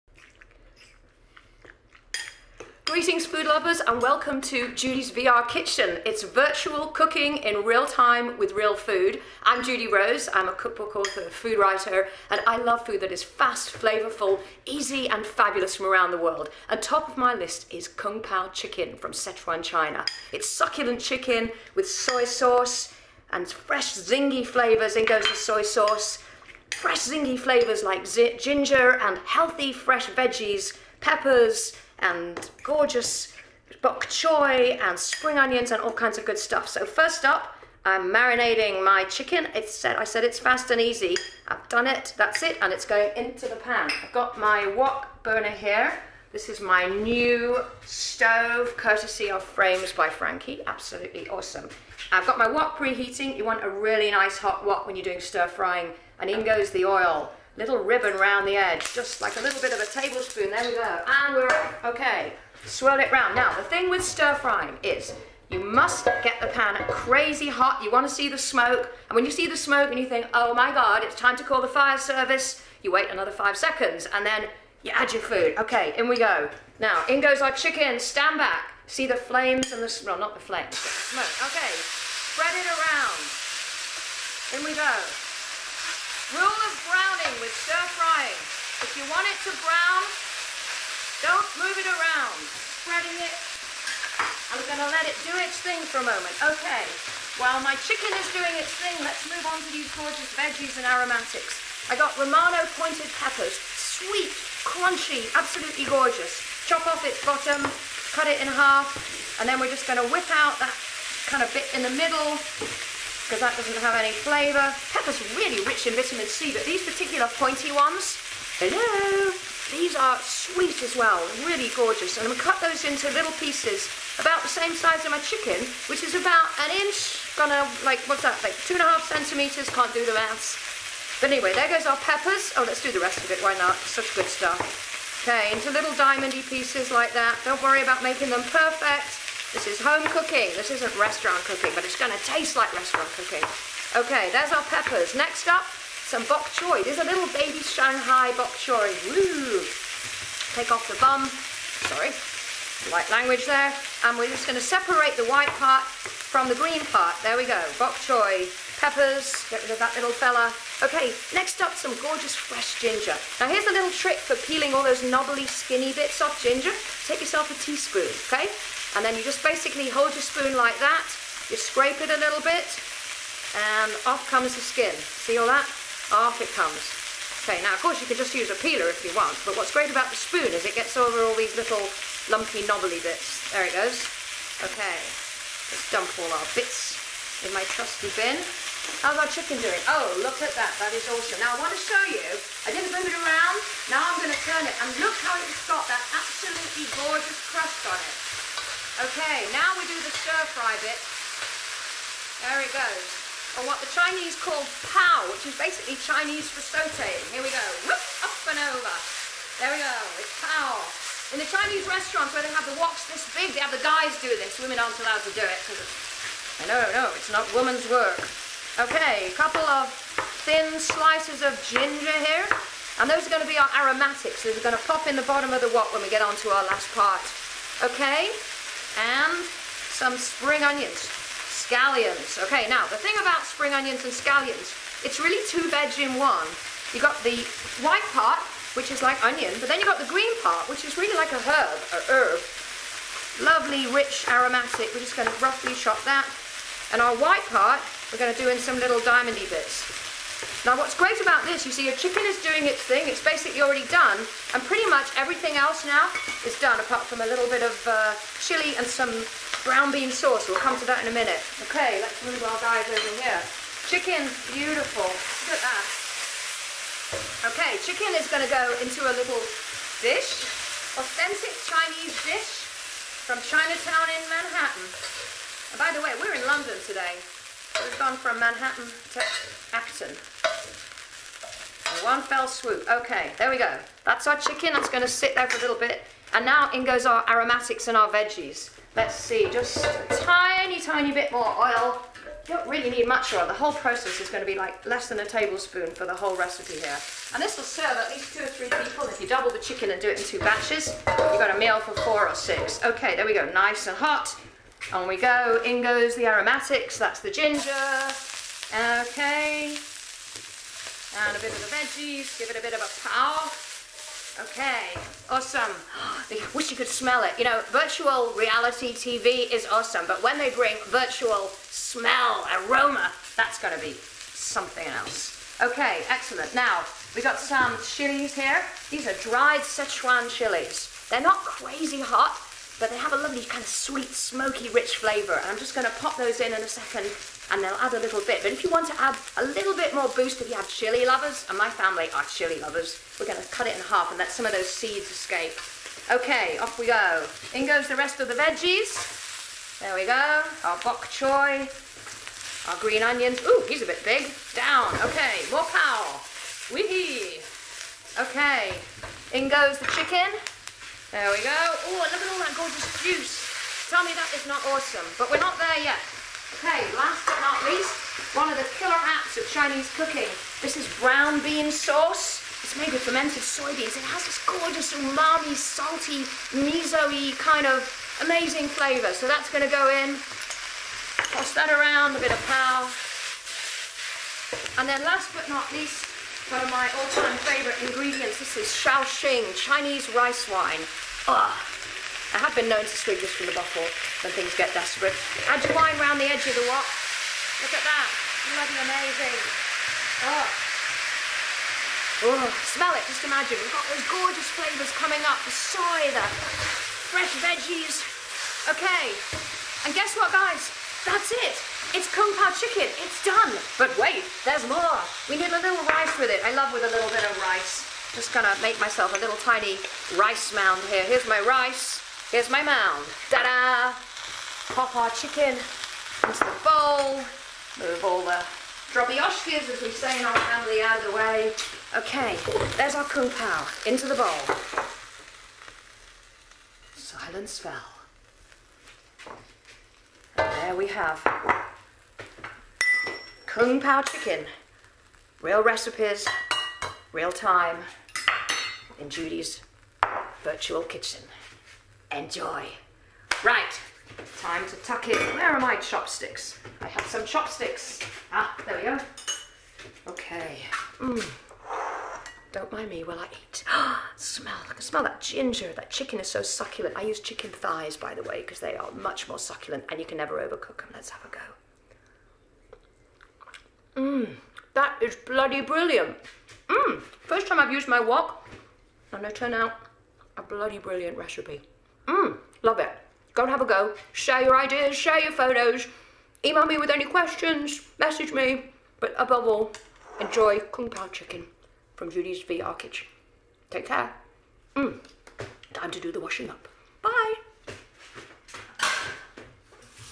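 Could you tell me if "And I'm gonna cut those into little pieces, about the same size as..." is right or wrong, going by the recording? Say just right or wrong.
right.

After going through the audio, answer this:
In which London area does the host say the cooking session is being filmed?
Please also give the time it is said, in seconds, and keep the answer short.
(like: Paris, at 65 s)
Acton, at 279 s.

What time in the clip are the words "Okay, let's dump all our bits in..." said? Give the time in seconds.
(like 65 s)
184 s.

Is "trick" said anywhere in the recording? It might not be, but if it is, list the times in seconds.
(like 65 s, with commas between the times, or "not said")
163 s.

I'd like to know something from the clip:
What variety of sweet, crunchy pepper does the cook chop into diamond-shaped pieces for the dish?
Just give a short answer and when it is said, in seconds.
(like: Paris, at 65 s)
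Romano pointed peppers, at 102 s.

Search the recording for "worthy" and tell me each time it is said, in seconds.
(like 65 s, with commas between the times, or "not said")
not said.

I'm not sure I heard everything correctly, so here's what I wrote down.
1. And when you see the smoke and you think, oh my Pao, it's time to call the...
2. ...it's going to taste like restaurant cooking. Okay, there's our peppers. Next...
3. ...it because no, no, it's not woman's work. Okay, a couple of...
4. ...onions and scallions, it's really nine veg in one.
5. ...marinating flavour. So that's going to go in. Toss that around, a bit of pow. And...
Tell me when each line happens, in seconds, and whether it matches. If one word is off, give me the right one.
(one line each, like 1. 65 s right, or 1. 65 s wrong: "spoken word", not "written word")
1. 69 s wrong: "God", not "Pao"
2. 141 s right
3. 215 s right
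4. 233 s wrong: "two", not "nine"
5. 378 s wrong: "amazing", not "marinating".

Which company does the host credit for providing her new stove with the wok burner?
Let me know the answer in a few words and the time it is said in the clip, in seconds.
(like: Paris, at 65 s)
Frames by Frankie, at 49 s.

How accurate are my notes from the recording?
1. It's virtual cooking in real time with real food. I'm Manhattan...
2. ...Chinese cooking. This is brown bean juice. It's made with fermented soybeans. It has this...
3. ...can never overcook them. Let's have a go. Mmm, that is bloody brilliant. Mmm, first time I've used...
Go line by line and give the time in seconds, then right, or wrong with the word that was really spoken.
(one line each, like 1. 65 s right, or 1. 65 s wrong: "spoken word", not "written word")
1. 6 s wrong: "Judy", not "Manhattan"
2. 369 s wrong: "sauce", not "juice"
3. 470 s right.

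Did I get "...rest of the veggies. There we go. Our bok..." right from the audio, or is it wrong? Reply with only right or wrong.
right.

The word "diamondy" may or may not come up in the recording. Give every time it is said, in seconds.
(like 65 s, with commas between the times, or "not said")
135 s, 248 s.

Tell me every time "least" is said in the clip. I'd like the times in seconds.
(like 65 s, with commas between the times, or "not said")
298 s, 367 s, 385 s.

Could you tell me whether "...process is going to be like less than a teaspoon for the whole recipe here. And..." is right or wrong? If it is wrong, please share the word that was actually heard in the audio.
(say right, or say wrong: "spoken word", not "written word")
wrong: "tablespoon", not "teaspoon".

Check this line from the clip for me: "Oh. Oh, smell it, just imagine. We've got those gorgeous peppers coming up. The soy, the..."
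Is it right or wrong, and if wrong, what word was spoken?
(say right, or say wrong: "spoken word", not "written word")
wrong: "flavours", not "peppers".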